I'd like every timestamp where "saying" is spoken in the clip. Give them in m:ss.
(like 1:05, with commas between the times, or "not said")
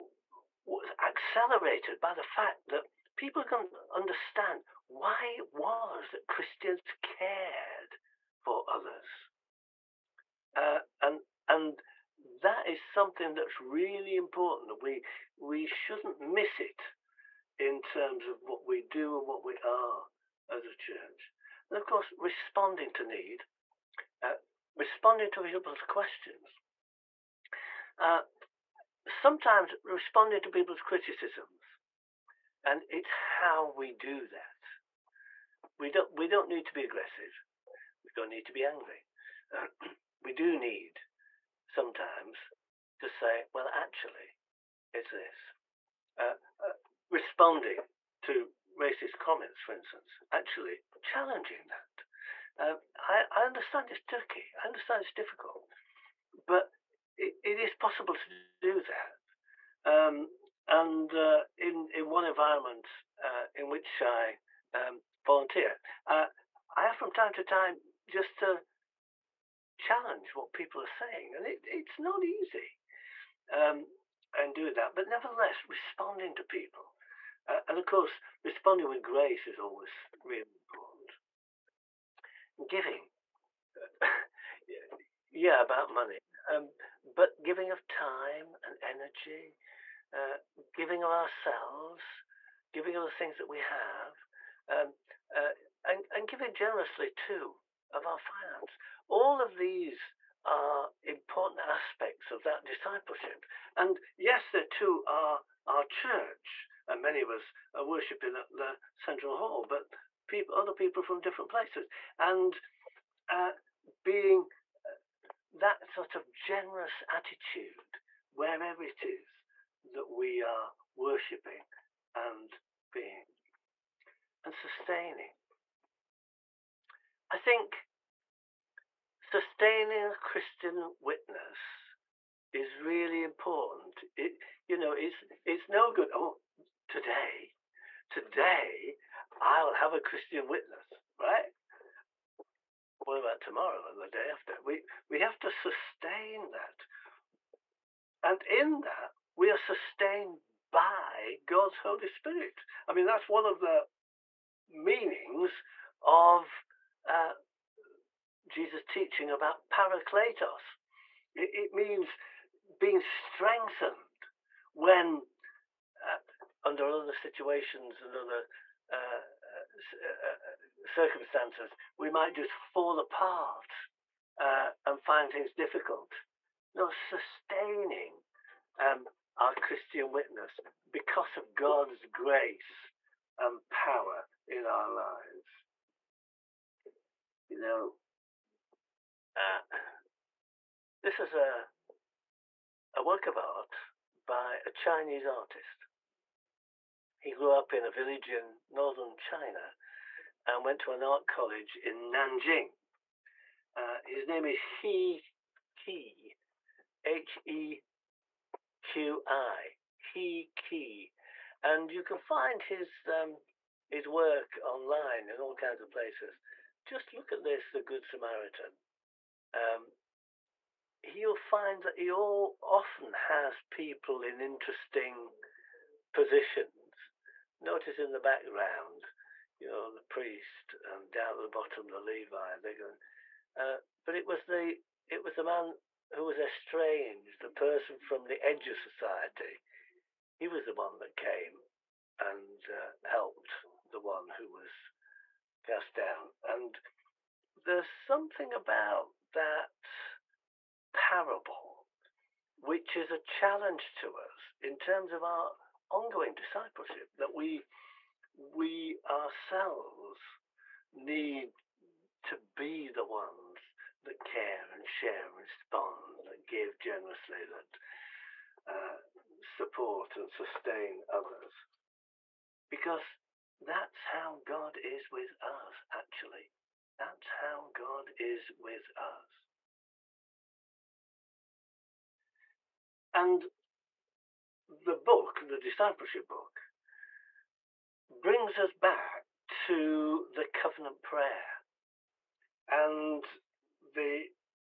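1:10.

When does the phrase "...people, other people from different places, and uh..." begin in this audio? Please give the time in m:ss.
1:50.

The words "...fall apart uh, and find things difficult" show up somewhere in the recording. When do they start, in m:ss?
2:52.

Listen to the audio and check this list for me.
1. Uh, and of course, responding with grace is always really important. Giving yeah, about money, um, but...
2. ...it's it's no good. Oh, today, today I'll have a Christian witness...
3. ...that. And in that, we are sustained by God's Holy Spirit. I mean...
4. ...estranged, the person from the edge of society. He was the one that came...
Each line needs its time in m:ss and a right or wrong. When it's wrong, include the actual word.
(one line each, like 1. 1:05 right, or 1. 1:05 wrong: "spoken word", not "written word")
1. 1:17 right
2. 2:14 right
3. 2:26 right
4. 3:56 right.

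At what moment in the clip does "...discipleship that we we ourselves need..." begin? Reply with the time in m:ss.
4:16.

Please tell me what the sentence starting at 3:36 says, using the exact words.
Just look at this, The Good Samaritan.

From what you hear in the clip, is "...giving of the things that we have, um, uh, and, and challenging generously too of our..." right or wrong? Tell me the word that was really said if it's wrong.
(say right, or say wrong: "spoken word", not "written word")
wrong: "giving", not "challenging".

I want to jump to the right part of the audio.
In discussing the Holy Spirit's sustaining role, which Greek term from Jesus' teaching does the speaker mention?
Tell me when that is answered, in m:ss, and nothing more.
2:39.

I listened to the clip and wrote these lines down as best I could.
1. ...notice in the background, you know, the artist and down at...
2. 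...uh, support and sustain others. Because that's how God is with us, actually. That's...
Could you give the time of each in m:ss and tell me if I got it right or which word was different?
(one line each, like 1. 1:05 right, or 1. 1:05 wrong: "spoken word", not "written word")
1. 3:47 wrong: "priest", not "artist"
2. 4:28 right.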